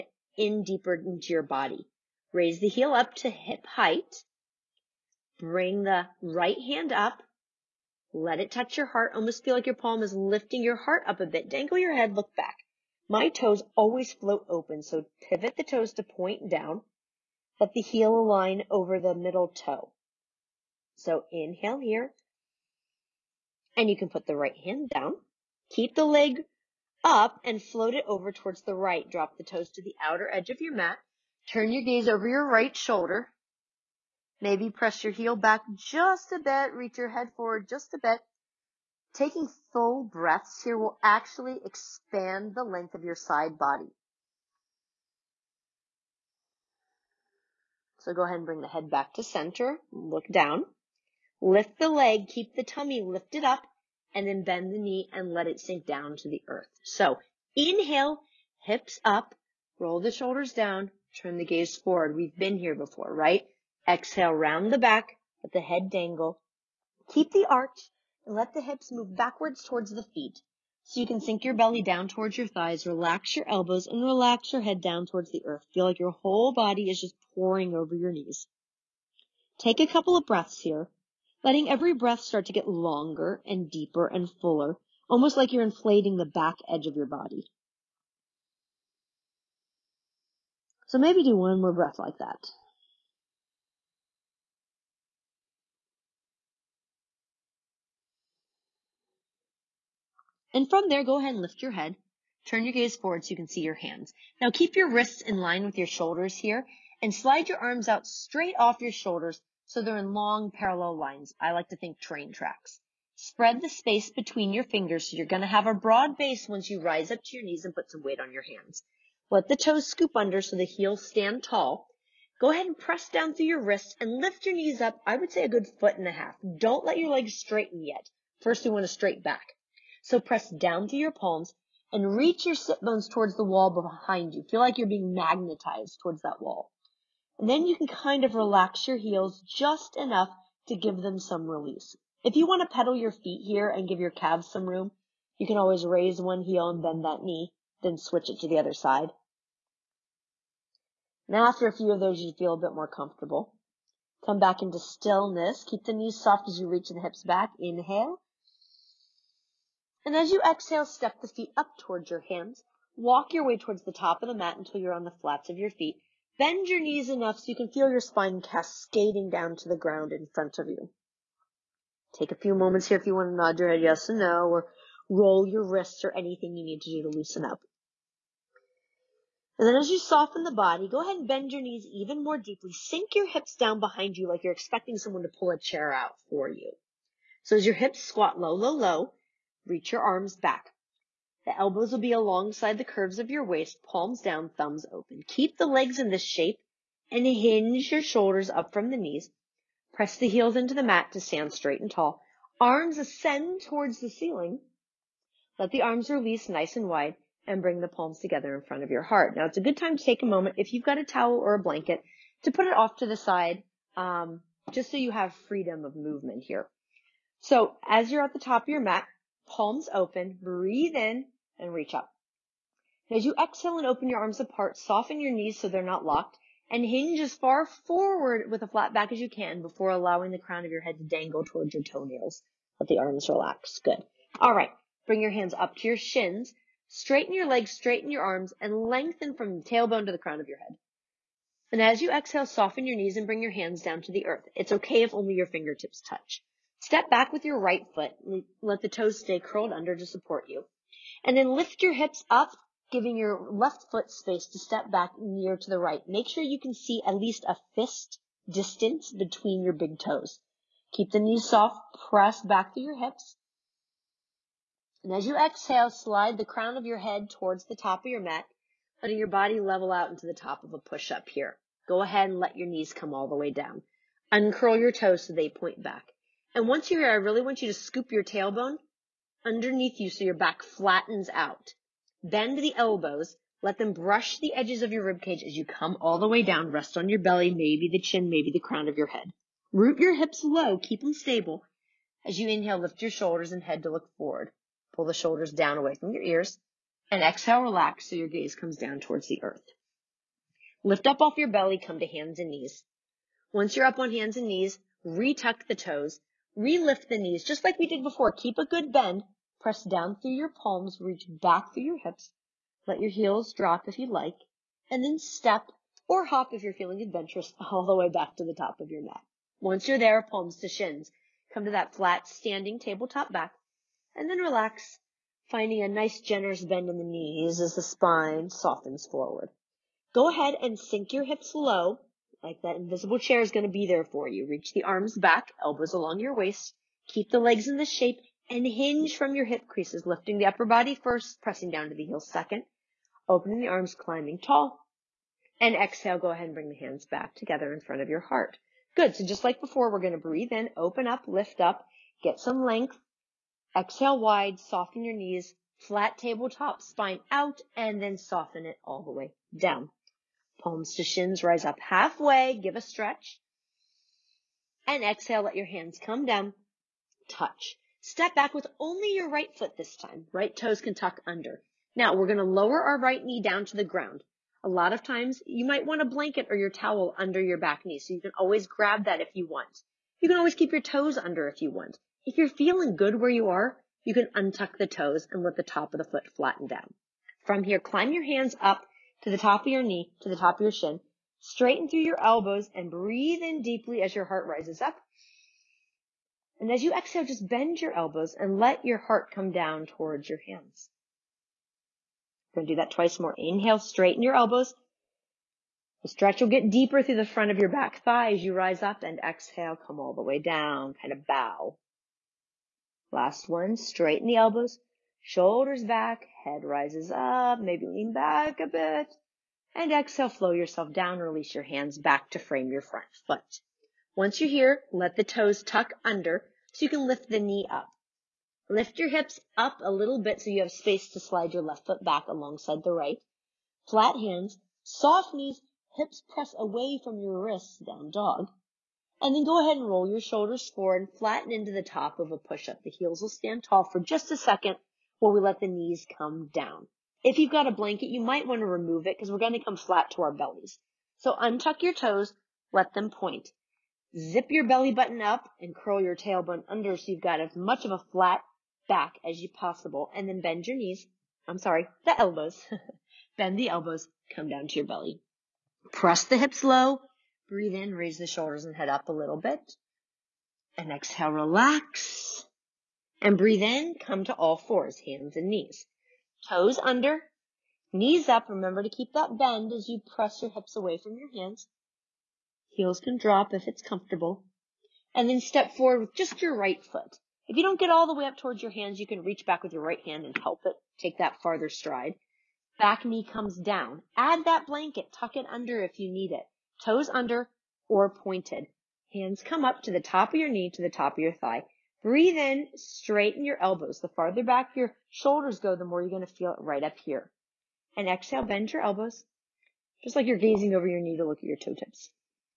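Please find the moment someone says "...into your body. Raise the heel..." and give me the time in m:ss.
0:00.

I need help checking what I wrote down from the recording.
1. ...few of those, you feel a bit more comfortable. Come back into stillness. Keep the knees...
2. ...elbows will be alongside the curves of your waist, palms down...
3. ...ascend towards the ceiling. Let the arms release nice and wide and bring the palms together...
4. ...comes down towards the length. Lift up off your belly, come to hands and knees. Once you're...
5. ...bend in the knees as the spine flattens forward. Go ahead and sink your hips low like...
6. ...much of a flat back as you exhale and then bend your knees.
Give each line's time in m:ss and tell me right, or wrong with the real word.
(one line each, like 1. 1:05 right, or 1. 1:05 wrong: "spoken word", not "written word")
1. 2:31 right
2. 3:11 right
3. 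3:22 right
4. 4:58 wrong: "earth", not "length"
5. 5:26 wrong: "softens", not "flattens"
6. 7:37 wrong: "possible", not "exhale".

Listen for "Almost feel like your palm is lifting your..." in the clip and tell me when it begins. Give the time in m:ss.
0:09.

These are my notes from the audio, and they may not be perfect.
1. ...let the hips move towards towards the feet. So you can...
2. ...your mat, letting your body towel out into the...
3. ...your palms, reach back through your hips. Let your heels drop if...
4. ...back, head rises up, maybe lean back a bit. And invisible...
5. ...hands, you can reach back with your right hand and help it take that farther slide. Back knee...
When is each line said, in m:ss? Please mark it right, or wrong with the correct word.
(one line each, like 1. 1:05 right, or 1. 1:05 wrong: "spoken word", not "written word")
1. 1:08 wrong: "backwards", not "towards"
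2. 4:28 wrong: "level", not "towel"
3. 5:10 right
4. 6:55 wrong: "exhale", not "invisible"
5. 8:08 wrong: "stride", not "slide".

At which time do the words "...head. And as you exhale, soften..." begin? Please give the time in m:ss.
4:00.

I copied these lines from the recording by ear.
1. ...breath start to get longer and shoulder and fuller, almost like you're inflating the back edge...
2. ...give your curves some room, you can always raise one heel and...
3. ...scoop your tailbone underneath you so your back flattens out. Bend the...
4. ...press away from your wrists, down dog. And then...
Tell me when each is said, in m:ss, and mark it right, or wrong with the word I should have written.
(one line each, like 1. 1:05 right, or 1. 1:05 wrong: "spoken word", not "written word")
1. 1:21 wrong: "deeper", not "shoulder"
2. 2:23 wrong: "calves", not "curves"
3. 4:37 right
4. 7:16 right.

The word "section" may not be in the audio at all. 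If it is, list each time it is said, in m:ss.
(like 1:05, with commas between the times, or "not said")
not said.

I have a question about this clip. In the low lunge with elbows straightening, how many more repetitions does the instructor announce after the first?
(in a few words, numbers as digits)
2.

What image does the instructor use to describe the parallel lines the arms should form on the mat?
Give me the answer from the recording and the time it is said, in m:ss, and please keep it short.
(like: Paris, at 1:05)
train tracks, at 1:51.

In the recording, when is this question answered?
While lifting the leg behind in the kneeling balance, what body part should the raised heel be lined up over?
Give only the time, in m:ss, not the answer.
0:18.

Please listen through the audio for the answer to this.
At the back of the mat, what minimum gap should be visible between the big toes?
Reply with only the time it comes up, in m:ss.
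4:17.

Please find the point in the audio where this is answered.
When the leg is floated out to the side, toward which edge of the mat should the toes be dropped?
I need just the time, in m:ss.
0:30.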